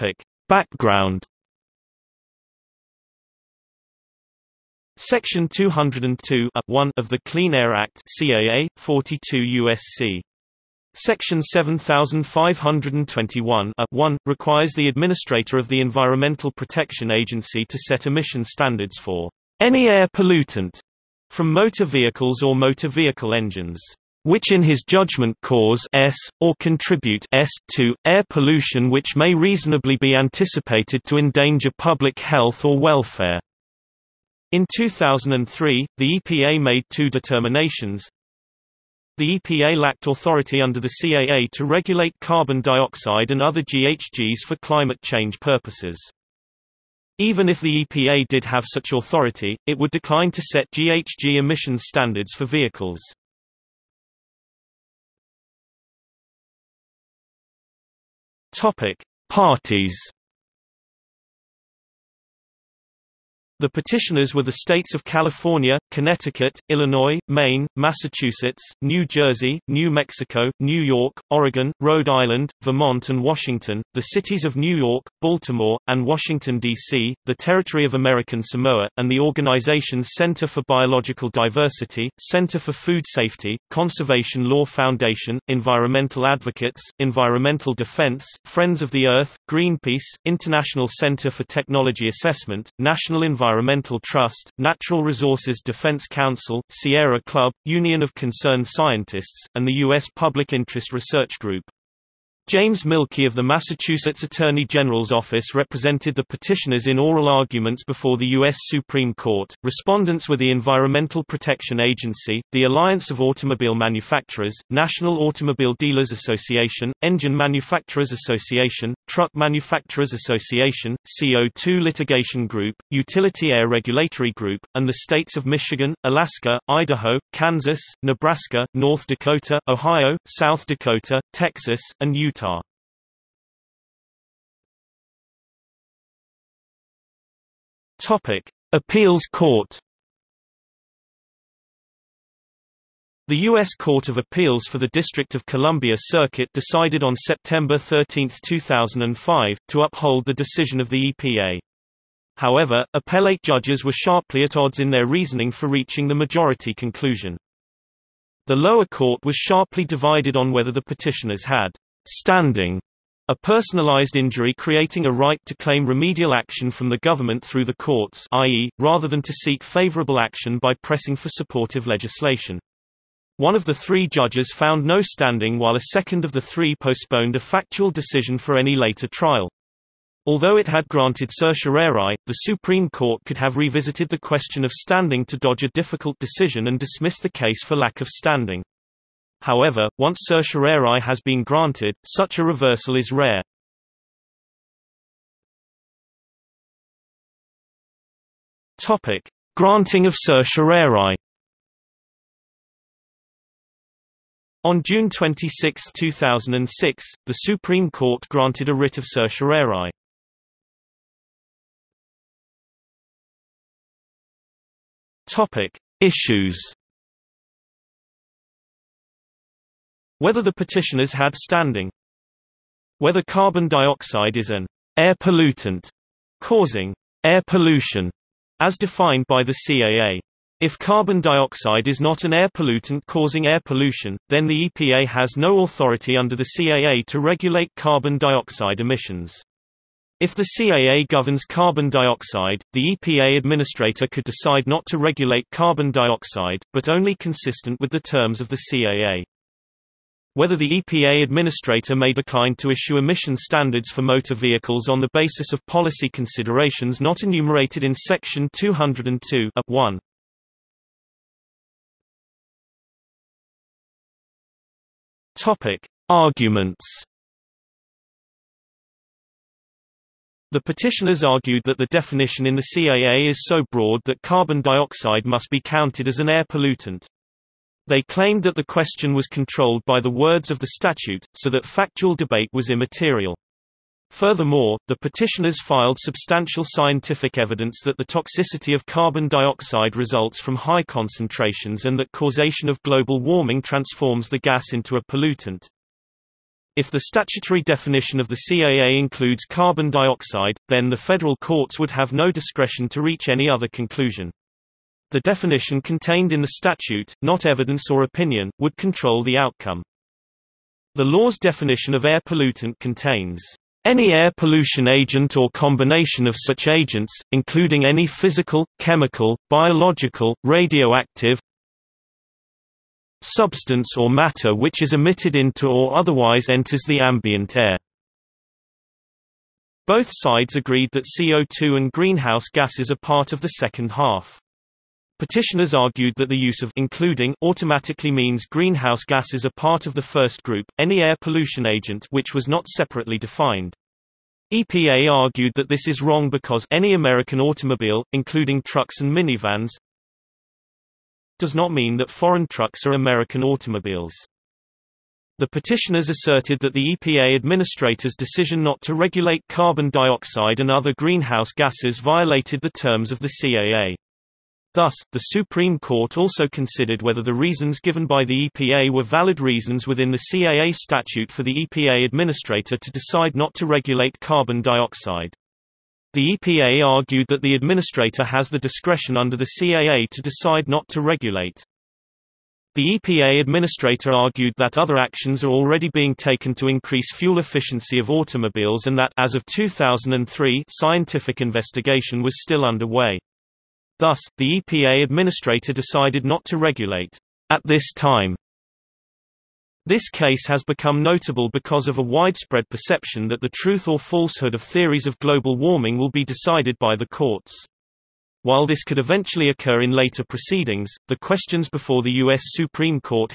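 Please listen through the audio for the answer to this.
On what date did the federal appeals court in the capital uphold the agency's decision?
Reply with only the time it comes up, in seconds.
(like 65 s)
147 s.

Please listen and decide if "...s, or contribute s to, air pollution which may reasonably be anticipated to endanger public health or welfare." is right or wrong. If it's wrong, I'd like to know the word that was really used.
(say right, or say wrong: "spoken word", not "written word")
right.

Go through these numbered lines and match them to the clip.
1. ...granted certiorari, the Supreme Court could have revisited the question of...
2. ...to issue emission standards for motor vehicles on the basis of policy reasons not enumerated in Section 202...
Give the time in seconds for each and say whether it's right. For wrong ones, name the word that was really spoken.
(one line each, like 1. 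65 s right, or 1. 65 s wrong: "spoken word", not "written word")
1. 180 s right
2. 252 s wrong: "considerations", not "reasons".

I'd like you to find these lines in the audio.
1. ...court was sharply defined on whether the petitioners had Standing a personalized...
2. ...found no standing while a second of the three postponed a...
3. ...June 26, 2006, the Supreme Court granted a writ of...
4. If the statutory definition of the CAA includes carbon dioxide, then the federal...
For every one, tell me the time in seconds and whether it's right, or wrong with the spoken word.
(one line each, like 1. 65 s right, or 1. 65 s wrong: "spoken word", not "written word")
1. 158 s wrong: "divided", not "defined"
2. 174 s right
3. 204 s right
4. 296 s right.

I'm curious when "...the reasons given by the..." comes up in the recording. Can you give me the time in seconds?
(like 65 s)
367 s.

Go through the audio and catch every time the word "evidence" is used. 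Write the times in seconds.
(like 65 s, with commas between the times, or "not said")
287 s, 307 s.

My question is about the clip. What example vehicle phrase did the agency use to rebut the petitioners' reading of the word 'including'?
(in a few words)
any American automobile.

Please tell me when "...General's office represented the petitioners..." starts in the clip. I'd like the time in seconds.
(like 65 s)
104 s.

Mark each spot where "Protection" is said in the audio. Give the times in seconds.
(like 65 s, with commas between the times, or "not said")
16 s, 111 s.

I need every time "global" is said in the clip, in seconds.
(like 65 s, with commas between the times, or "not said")
292 s, 405 s.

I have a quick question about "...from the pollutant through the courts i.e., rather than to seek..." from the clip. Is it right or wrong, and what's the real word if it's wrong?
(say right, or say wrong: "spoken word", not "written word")
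wrong: "government", not "pollutant".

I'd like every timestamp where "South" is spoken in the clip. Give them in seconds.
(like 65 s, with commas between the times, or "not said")
130 s.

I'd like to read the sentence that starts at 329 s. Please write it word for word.
Both sides agreed that CO2 and greenhouse gases are part of the second half.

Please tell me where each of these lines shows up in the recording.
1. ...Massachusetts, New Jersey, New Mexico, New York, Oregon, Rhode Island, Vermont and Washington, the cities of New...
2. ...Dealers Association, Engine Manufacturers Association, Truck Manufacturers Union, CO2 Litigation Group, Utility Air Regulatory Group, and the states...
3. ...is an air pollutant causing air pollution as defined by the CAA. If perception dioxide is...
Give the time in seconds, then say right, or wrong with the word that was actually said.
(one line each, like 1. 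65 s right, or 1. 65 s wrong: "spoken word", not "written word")
1. 67 s right
2. 115 s wrong: "Association", not "Union"
3. 224 s wrong: "carbon", not "perception".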